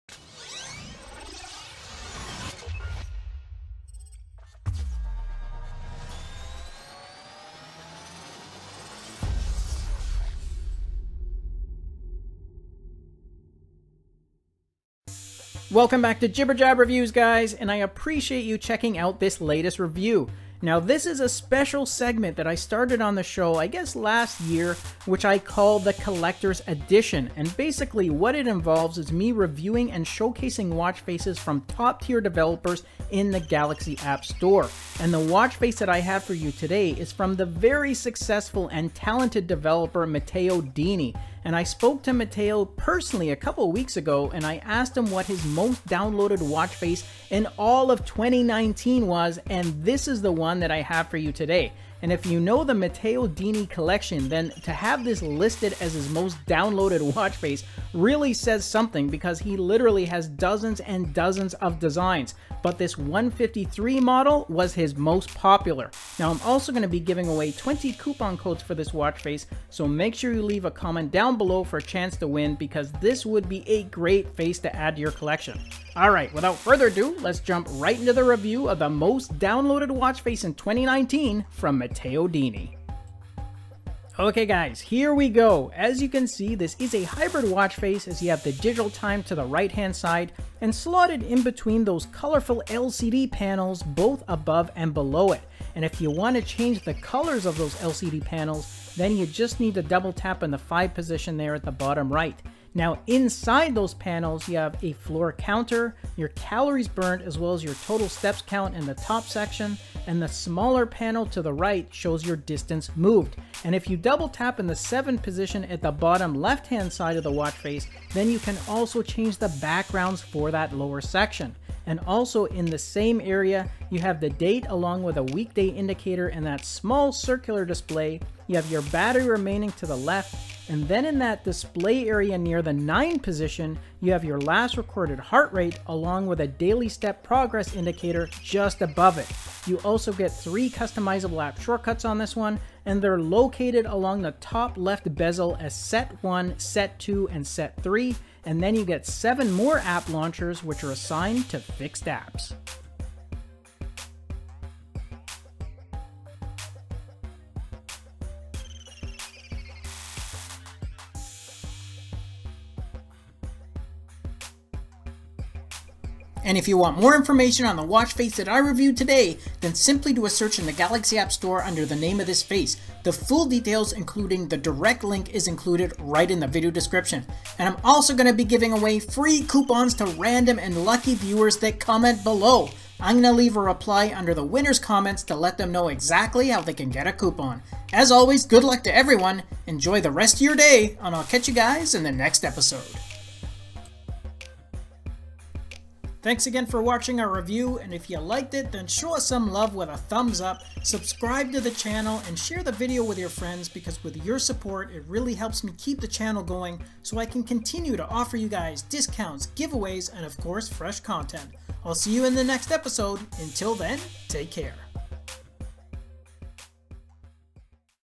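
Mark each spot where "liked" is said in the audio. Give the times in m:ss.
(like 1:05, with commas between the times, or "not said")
3:18.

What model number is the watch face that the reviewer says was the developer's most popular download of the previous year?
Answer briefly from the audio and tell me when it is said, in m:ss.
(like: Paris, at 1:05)
153, at 1:02.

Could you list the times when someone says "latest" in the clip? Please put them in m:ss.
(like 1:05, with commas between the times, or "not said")
0:19.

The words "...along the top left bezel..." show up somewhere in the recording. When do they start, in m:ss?
2:23.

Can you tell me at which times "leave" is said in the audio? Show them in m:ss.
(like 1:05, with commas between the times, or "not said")
1:10, 3:03.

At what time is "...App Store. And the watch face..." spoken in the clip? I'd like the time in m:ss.
0:33.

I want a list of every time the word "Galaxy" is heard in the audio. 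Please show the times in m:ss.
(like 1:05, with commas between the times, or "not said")
0:33, 2:50.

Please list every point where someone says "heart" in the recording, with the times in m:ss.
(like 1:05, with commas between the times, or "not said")
2:15.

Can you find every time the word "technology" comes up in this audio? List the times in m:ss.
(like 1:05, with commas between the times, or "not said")
not said.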